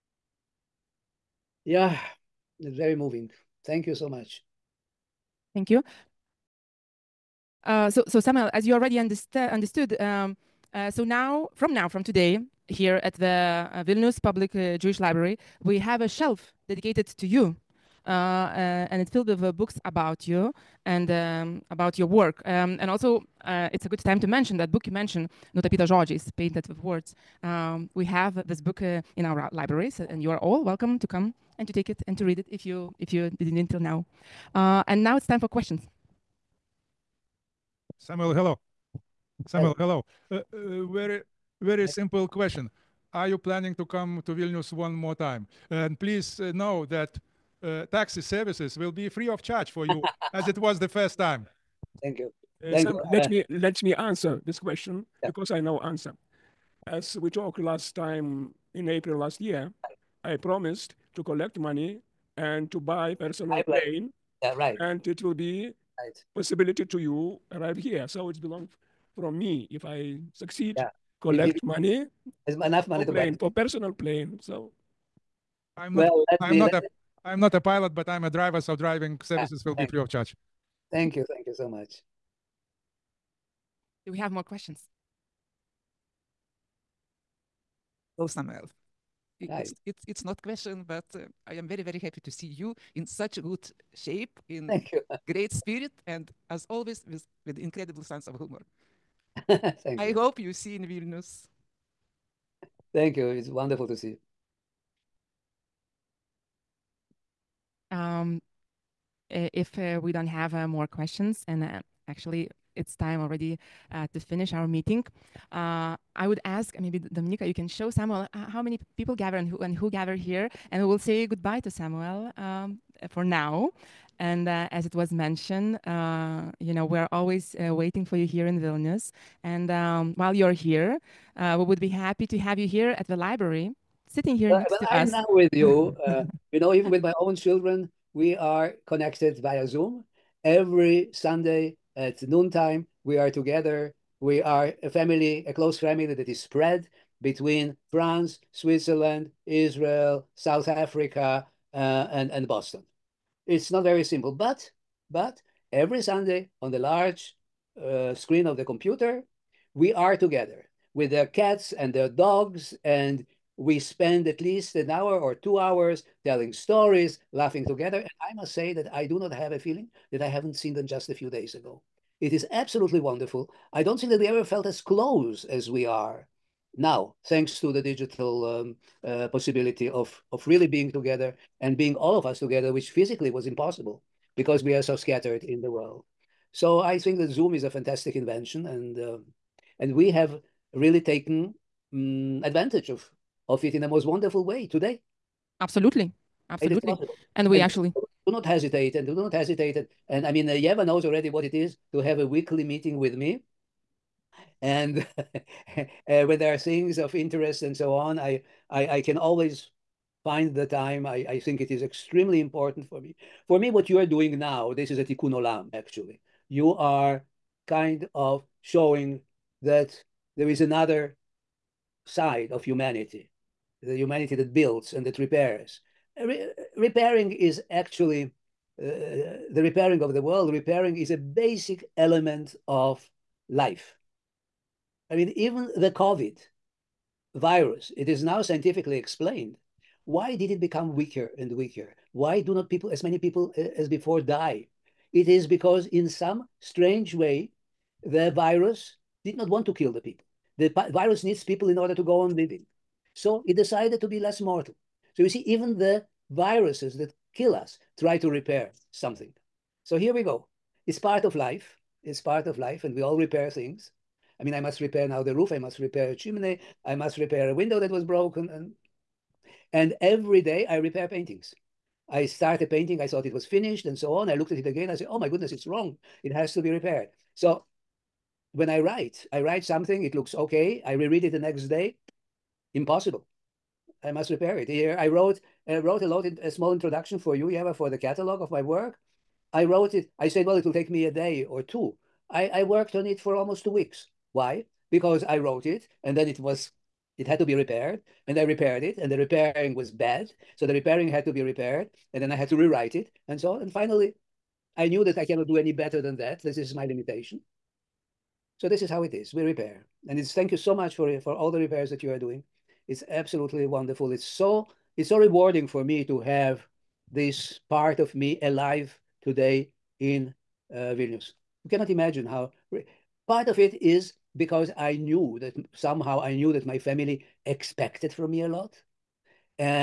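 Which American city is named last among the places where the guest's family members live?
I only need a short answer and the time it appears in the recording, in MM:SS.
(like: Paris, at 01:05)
Boston, at 02:32.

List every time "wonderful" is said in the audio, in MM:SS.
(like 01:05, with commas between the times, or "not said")
01:43, 02:52, 03:14, 05:13.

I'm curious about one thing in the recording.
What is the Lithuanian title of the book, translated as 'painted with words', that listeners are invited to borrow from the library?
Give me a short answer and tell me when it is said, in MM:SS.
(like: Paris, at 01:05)
Nutapyta žodžiais, at 00:25.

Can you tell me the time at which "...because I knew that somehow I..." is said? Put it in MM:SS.
05:24.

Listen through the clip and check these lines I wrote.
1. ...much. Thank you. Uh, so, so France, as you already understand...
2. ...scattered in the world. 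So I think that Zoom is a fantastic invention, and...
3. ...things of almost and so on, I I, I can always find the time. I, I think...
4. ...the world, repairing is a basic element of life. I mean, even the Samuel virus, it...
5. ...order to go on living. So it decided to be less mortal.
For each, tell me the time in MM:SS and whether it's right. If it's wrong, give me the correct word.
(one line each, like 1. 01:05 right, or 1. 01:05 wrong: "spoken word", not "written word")
1. 00:04 wrong: "Samuel", not "France"
2. 03:04 right
3. 03:26 wrong: "interest", not "almost"
4. 03:50 wrong: "COVID", not "Samuel"
5. 04:11 right.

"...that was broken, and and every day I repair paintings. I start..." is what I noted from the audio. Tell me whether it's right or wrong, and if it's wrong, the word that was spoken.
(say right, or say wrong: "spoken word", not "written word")
right.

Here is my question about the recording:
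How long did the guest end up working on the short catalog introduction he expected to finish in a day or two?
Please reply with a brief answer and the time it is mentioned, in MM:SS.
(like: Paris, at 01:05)
Almost two weeks, at 04:53.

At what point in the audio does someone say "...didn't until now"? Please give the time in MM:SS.
00:33.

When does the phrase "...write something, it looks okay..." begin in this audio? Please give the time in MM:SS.
04:39.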